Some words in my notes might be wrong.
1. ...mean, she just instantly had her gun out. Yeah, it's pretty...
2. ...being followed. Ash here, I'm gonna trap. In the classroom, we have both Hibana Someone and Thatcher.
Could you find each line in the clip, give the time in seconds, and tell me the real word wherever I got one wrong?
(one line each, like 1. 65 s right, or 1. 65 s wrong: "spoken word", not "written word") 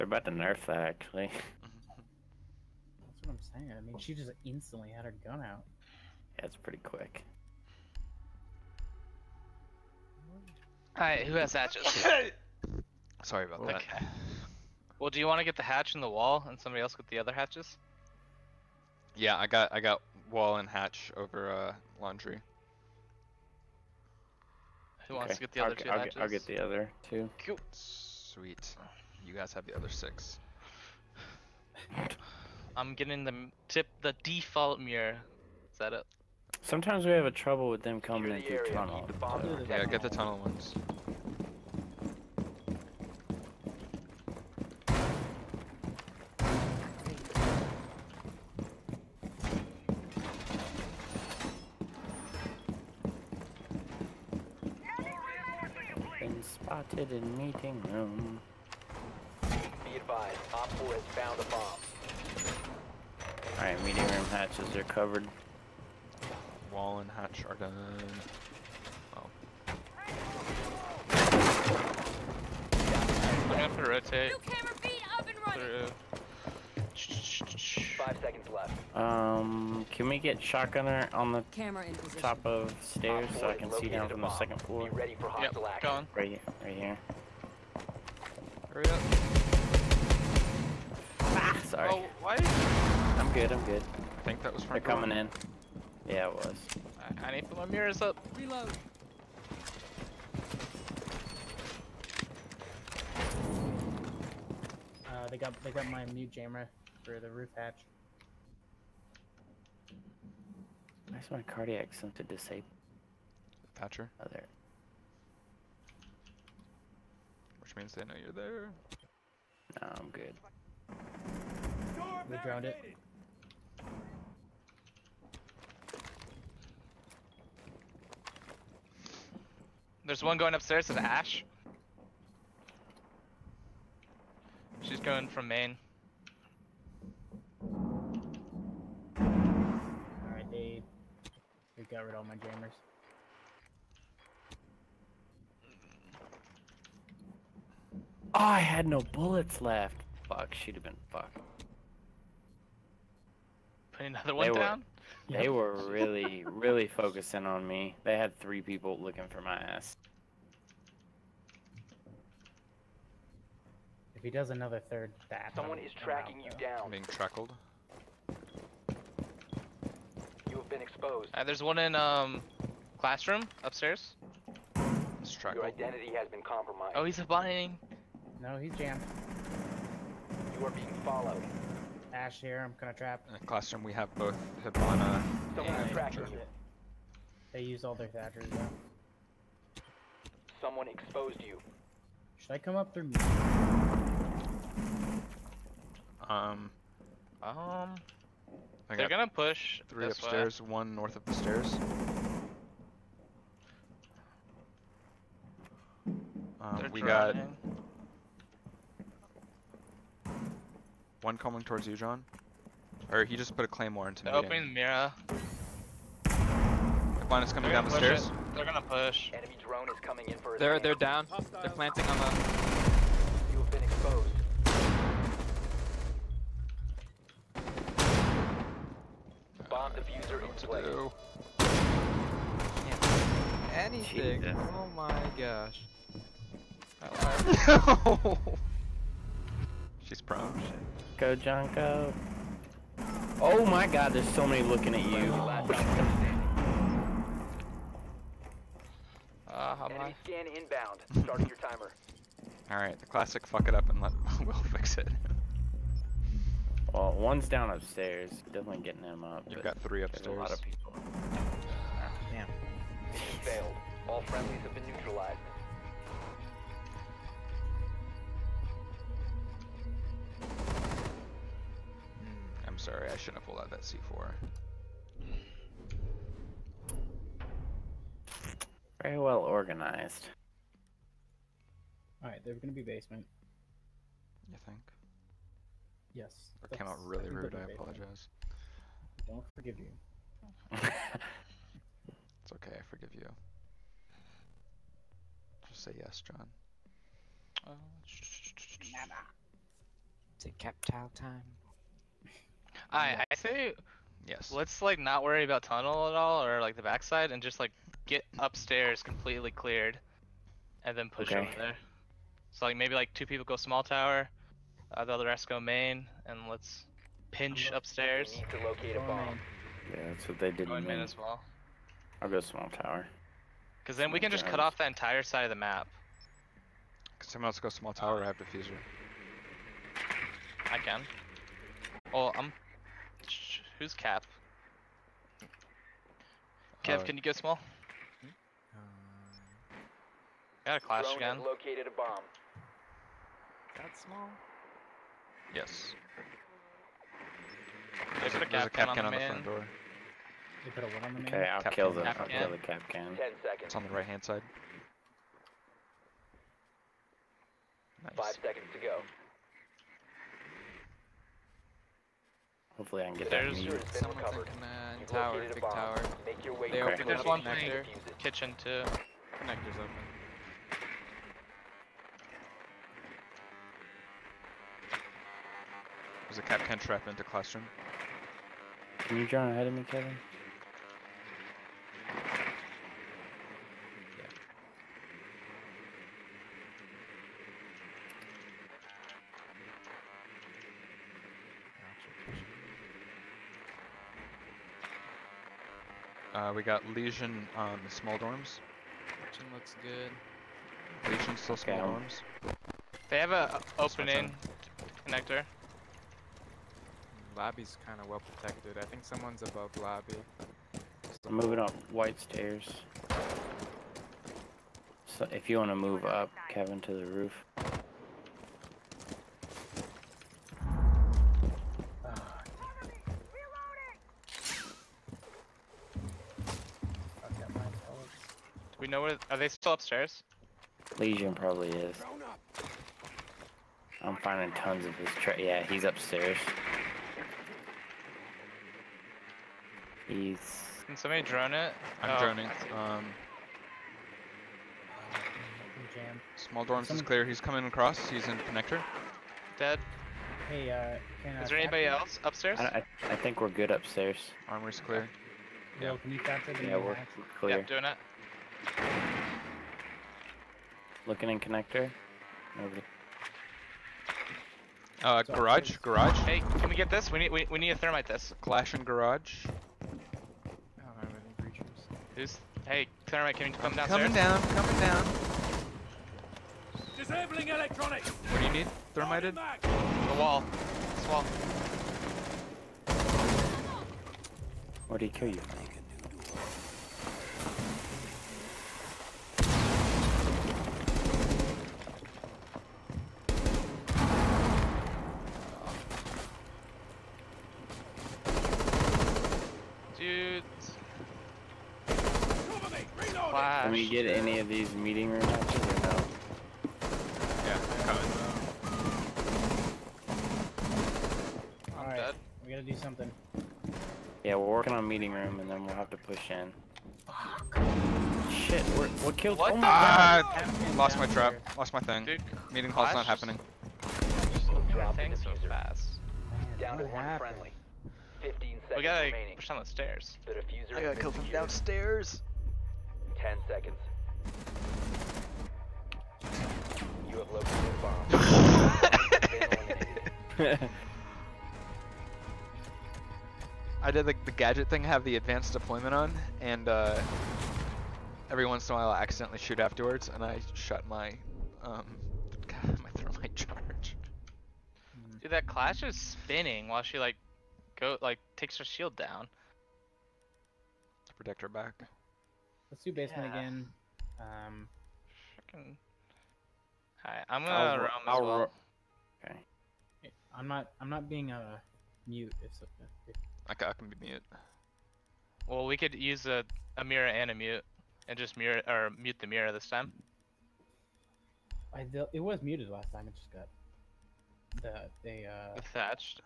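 1. 3 s right
2. 180 s right.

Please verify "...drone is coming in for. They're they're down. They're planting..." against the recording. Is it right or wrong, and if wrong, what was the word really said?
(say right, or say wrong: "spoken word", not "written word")
right.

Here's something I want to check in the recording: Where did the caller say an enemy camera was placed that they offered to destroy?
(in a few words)
front door.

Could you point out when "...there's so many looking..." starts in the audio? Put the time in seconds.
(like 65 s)
244 s.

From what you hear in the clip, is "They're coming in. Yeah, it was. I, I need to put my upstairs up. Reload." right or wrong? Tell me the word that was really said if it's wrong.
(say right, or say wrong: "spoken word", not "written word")
wrong: "mirrors", not "upstairs".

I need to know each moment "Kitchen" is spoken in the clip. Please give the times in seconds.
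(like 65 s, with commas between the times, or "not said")
368 s.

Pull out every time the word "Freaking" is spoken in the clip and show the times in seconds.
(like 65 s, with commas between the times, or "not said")
565 s.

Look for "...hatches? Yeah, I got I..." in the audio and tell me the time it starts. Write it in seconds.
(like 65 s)
17 s.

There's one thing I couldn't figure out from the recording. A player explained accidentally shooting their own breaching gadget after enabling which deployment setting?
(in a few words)
advanced deployment.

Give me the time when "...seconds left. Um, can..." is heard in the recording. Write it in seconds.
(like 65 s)
78 s.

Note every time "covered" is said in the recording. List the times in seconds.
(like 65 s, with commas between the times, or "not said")
64 s, 364 s.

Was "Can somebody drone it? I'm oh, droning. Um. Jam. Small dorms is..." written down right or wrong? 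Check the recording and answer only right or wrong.
right.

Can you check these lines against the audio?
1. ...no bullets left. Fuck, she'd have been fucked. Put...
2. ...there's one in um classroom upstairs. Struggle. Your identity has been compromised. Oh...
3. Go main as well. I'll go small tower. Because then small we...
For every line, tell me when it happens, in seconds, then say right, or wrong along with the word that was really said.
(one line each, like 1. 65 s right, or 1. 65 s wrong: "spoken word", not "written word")
1. 148 s right
2. 171 s right
3. 320 s right.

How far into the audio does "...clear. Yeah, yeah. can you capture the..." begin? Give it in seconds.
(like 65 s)
454 s.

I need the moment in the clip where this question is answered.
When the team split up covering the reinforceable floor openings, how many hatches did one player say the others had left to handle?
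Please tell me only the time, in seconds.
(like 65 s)
29 s.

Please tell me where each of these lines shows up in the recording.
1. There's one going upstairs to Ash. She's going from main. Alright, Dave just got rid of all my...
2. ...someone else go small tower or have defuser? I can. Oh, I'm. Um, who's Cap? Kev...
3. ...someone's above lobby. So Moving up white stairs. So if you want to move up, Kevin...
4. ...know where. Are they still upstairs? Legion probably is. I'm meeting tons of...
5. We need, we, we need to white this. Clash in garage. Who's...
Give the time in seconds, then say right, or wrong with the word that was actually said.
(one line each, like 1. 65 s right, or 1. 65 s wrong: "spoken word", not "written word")
1. 130 s right
2. 327 s right
3. 409 s right
4. 428 s wrong: "finding", not "meeting"
5. 467 s wrong: "thermite", not "white".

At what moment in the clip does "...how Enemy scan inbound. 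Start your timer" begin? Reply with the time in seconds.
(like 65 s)
249 s.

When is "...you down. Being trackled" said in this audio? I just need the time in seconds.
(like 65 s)
166 s.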